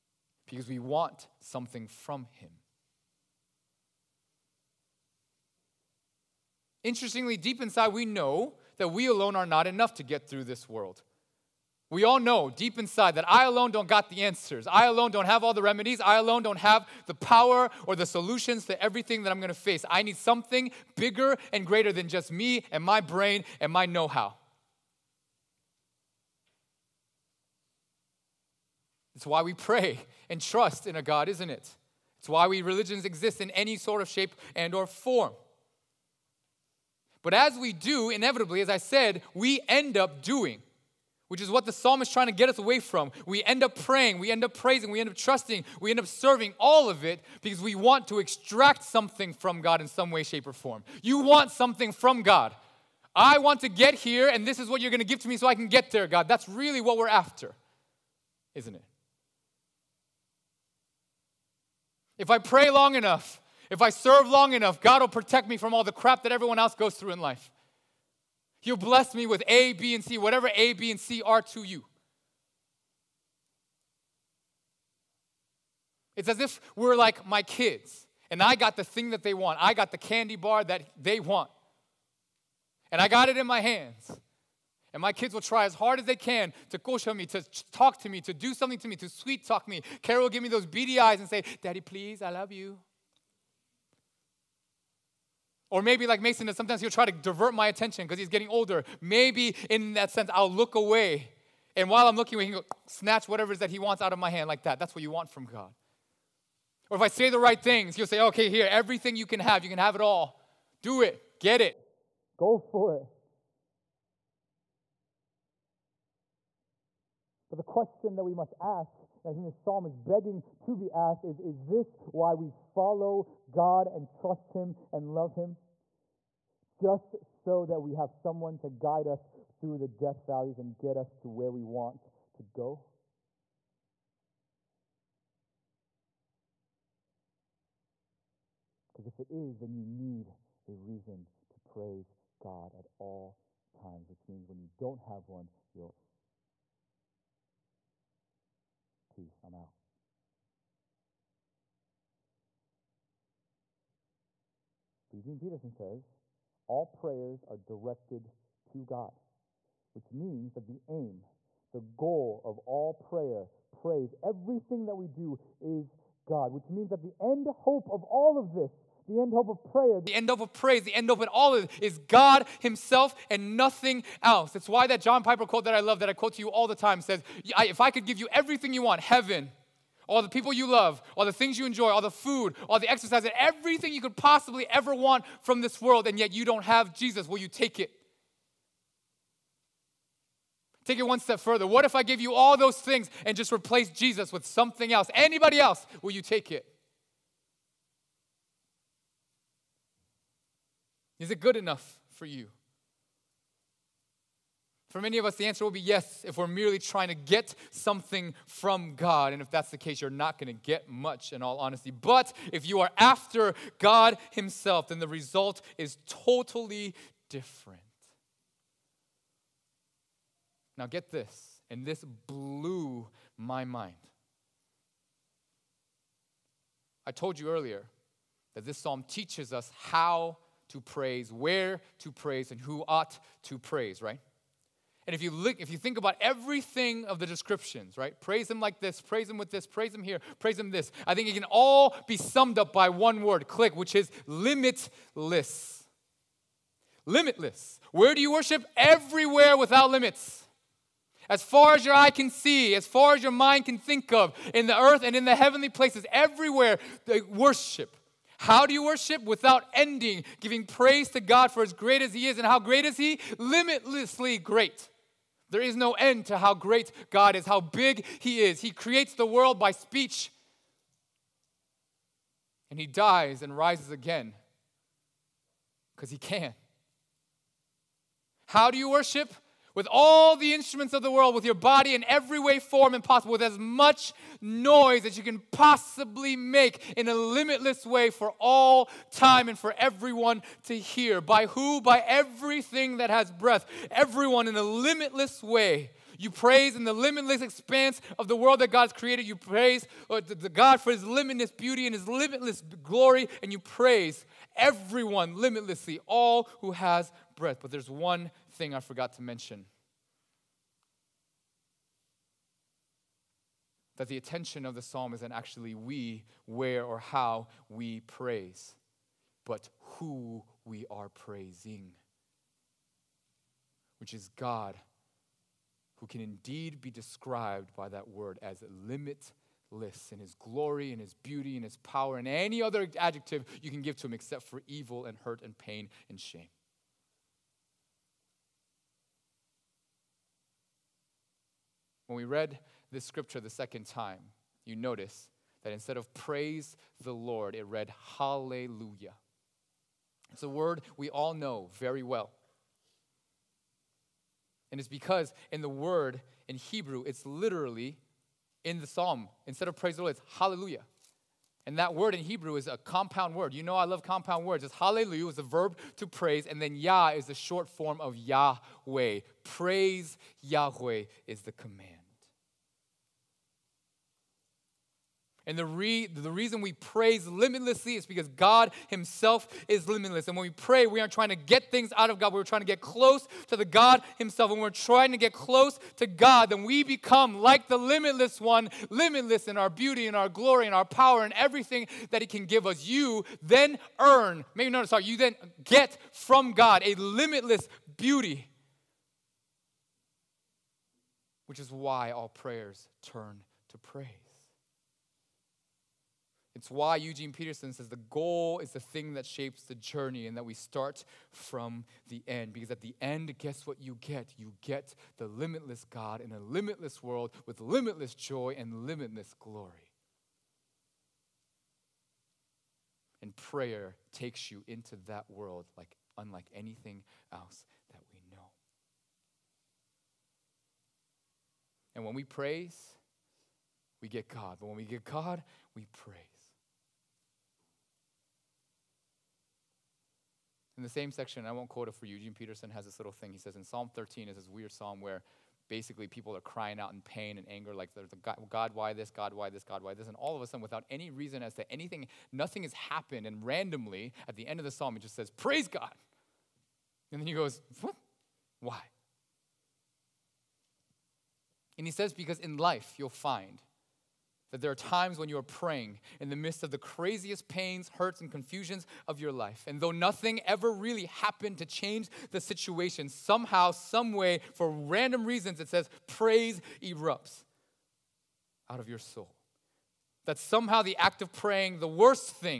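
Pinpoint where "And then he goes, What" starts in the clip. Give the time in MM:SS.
07:37.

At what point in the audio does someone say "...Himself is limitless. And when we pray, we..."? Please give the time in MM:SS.
06:18.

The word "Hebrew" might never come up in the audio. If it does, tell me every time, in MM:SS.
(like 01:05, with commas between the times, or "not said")
05:56, 06:02.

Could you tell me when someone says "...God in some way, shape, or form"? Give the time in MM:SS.
00:49.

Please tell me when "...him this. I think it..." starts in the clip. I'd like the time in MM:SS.
04:00.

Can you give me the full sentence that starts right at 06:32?
You then earn, maybe notice, sorry, you then get from God a limitless beauty, which is why all prayers turn to praise.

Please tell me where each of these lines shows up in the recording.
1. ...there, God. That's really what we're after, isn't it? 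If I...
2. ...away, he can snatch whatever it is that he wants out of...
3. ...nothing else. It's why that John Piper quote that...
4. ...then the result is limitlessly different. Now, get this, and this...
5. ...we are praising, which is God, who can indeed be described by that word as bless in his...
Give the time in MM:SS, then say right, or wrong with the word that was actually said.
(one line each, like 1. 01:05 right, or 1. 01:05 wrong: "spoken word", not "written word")
1. 00:55 right
2. 01:42 right
3. 02:53 right
4. 03:34 wrong: "totally", not "limitlessly"
5. 05:20 wrong: "limitless", not "bless".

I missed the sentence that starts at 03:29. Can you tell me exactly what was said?
And if that's the case, you're not going to get much in all honesty.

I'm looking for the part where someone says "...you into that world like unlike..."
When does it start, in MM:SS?
07:04.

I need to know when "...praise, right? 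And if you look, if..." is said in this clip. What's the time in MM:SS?
03:53.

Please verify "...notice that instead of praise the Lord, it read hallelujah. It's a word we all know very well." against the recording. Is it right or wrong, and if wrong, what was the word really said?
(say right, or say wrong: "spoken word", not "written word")
right.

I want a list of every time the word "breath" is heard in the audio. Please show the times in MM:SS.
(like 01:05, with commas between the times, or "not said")
04:53, 05:07.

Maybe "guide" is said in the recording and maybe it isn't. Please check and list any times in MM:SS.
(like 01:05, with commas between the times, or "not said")
02:08.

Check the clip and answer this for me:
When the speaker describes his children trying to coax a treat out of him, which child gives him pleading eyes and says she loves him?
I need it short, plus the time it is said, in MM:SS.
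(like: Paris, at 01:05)
Kara, at 01:30.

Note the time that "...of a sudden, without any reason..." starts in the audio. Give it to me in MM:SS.
07:30.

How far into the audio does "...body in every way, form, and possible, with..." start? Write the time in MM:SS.
04:41.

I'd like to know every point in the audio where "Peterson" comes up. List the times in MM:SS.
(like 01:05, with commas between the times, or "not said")
02:35, 06:47, 07:22.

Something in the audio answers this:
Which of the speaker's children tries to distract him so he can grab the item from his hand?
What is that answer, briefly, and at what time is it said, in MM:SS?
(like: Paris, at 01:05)
Mason, at 01:36.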